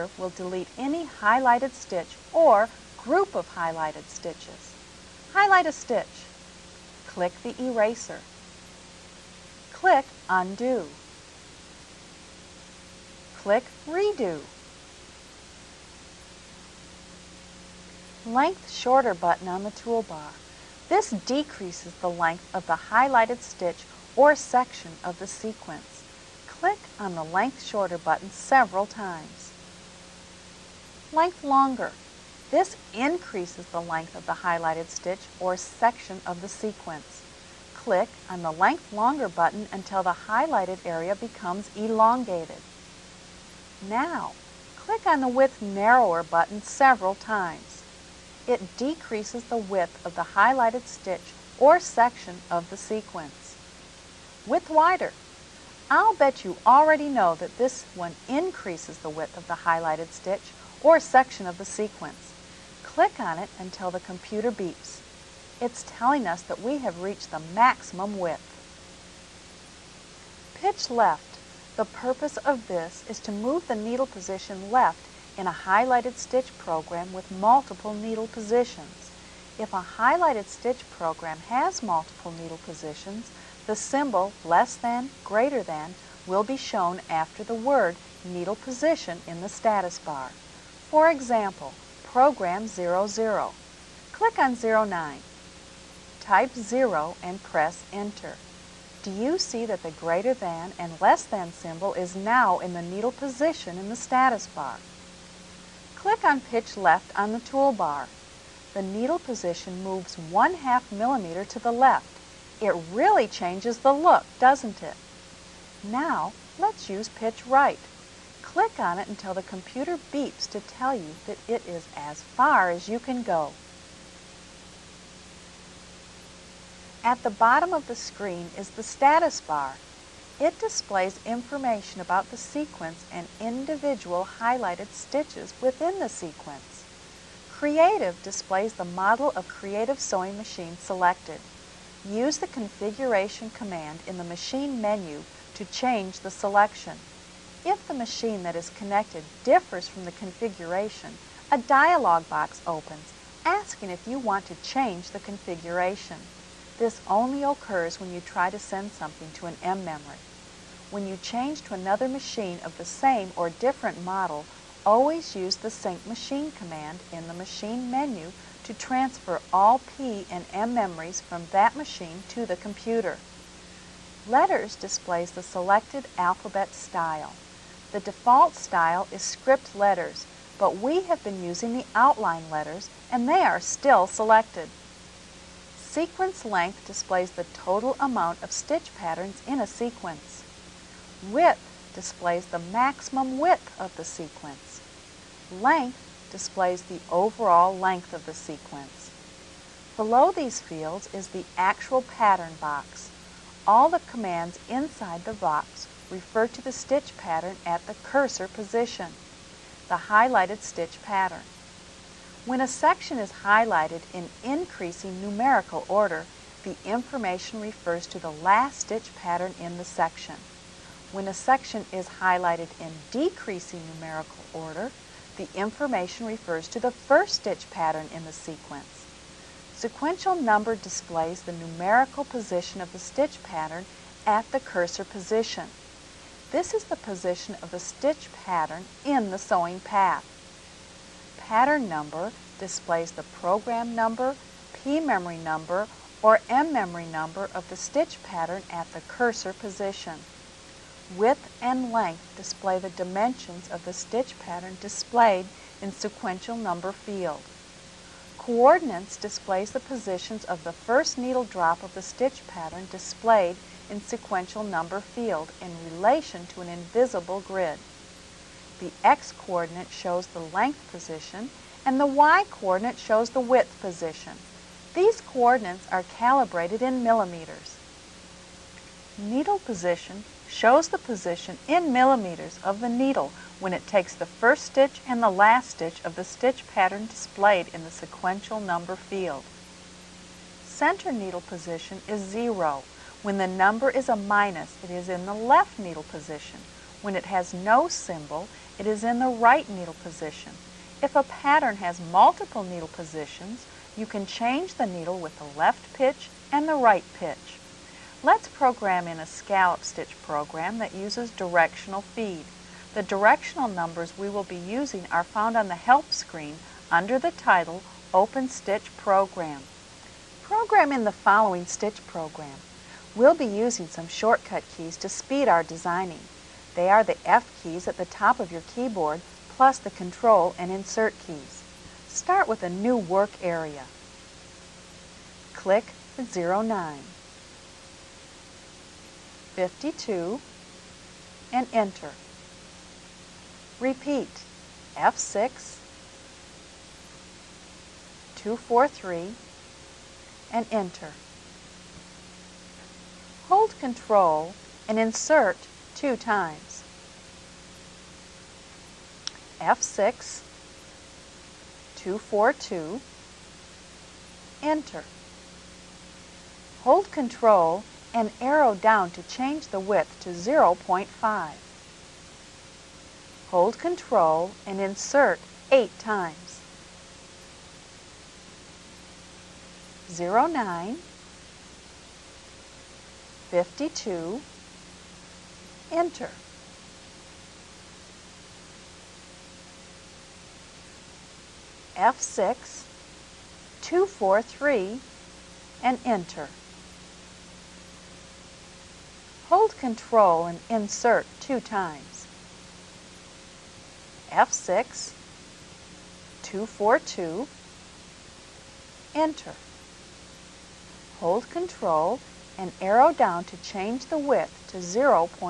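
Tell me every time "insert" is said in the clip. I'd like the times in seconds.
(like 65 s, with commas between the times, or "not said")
330 s, 354 s, 374 s, 400 s.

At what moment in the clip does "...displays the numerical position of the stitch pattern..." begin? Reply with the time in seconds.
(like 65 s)
230 s.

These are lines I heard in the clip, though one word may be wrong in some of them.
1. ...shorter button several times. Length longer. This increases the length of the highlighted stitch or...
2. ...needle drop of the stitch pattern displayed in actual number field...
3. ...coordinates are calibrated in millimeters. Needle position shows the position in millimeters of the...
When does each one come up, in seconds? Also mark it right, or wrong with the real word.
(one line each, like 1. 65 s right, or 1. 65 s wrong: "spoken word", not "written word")
1. 27 s right
2. 261 s wrong: "sequential", not "actual"
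3. 275 s right.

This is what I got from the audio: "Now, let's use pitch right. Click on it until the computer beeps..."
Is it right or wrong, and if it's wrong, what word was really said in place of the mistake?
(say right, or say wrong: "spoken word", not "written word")
right.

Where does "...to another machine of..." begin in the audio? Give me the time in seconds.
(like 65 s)
161 s.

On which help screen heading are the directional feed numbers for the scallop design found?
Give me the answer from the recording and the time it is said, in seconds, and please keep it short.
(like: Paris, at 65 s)
Open Stitch Program, at 318 s.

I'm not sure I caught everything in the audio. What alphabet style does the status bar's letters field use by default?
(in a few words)
script letters.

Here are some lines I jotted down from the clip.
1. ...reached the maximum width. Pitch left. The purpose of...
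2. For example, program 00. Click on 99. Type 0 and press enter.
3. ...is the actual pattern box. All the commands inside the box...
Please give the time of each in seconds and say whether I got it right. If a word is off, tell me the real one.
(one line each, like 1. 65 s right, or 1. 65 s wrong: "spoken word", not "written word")
1. 67 s right
2. 90 s wrong: "09", not "99"
3. 201 s right.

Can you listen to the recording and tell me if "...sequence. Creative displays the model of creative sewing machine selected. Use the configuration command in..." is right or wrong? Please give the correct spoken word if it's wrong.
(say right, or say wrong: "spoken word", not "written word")
right.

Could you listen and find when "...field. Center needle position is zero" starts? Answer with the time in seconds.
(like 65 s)
288 s.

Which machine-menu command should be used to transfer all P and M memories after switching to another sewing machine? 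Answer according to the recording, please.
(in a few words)
sync machine.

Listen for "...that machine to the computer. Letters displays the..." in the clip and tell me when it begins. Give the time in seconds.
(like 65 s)
171 s.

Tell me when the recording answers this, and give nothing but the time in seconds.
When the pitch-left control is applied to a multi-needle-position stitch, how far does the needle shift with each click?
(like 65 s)
110 s.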